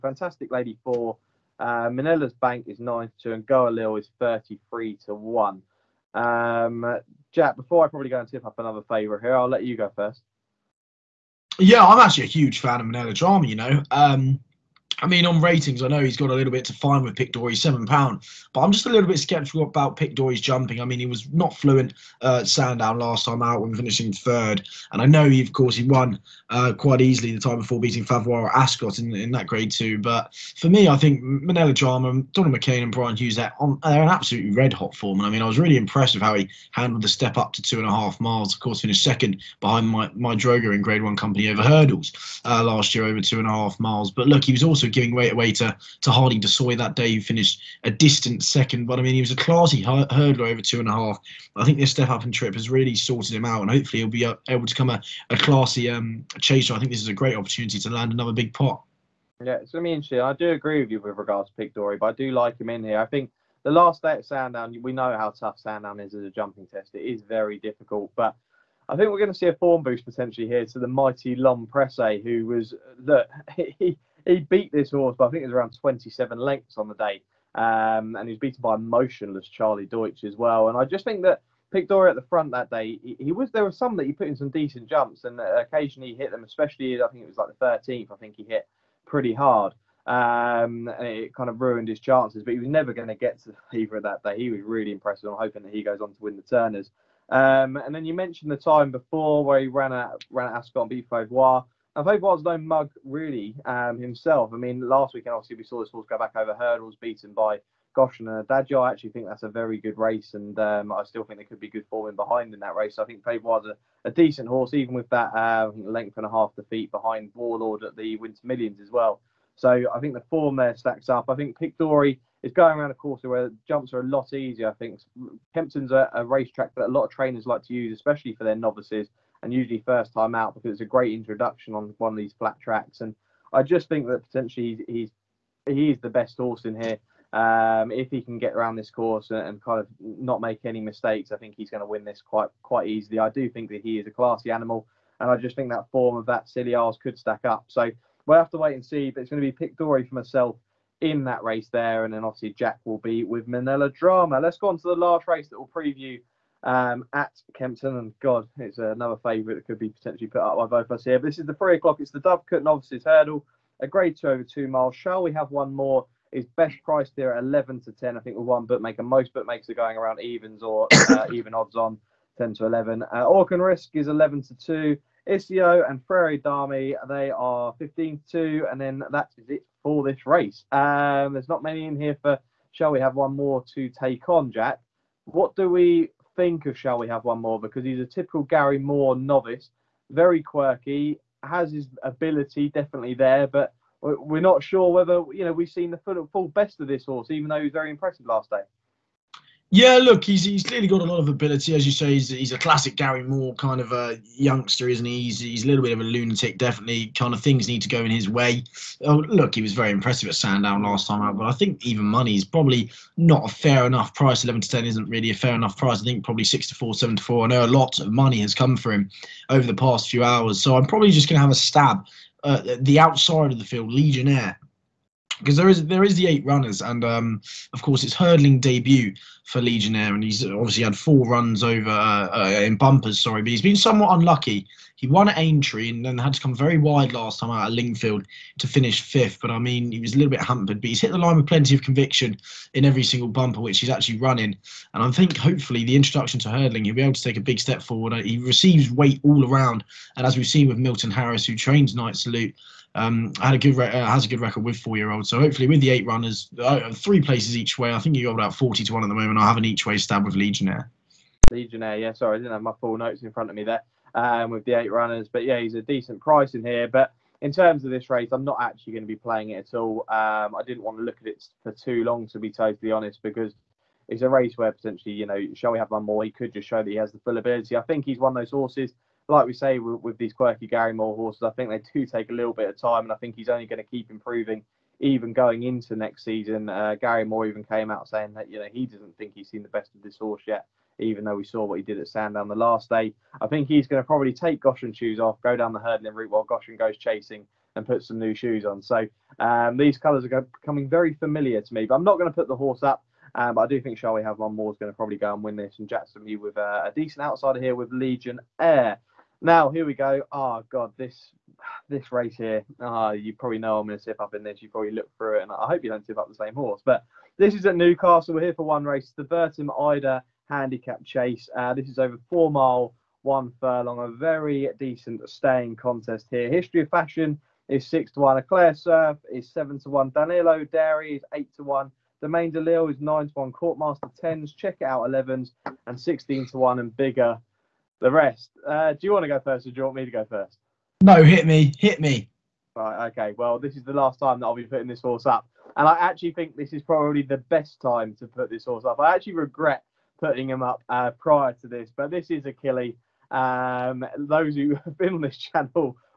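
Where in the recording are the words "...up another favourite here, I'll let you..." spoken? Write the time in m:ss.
0:08.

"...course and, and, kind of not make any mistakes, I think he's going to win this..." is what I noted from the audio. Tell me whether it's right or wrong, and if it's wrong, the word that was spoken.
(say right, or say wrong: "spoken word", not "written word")
right.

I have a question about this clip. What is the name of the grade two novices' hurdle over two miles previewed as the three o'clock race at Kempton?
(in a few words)
Dovecote Novices Hurdle.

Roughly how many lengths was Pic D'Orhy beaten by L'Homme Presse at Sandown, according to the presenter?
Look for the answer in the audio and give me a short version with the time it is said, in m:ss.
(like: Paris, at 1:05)
27, at 1:15.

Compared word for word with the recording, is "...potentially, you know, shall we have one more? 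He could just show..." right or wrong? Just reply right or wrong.
right.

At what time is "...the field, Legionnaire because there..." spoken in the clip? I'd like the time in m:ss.
3:43.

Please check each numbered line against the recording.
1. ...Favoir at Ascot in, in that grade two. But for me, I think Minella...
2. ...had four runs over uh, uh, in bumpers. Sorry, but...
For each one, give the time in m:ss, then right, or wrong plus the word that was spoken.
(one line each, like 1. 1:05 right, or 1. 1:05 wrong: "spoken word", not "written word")
1. 0:28 right
2. 3:50 right.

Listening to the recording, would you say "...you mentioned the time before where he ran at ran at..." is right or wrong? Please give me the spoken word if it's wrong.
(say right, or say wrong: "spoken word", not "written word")
right.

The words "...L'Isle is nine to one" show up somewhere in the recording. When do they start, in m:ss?
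5:32.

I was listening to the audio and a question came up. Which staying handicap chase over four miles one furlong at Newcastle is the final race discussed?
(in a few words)
Eider Handicap Chase.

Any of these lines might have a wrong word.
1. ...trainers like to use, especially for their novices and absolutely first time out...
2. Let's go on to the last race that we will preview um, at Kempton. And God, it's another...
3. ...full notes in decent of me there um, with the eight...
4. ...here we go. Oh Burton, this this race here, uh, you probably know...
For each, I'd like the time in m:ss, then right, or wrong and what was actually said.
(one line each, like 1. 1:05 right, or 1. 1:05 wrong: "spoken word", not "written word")
1. 2:07 wrong: "usually", not "absolutely"
2. 2:34 right
3. 4:22 wrong: "front", not "decent"
4. 5:09 wrong: "God", not "Burton".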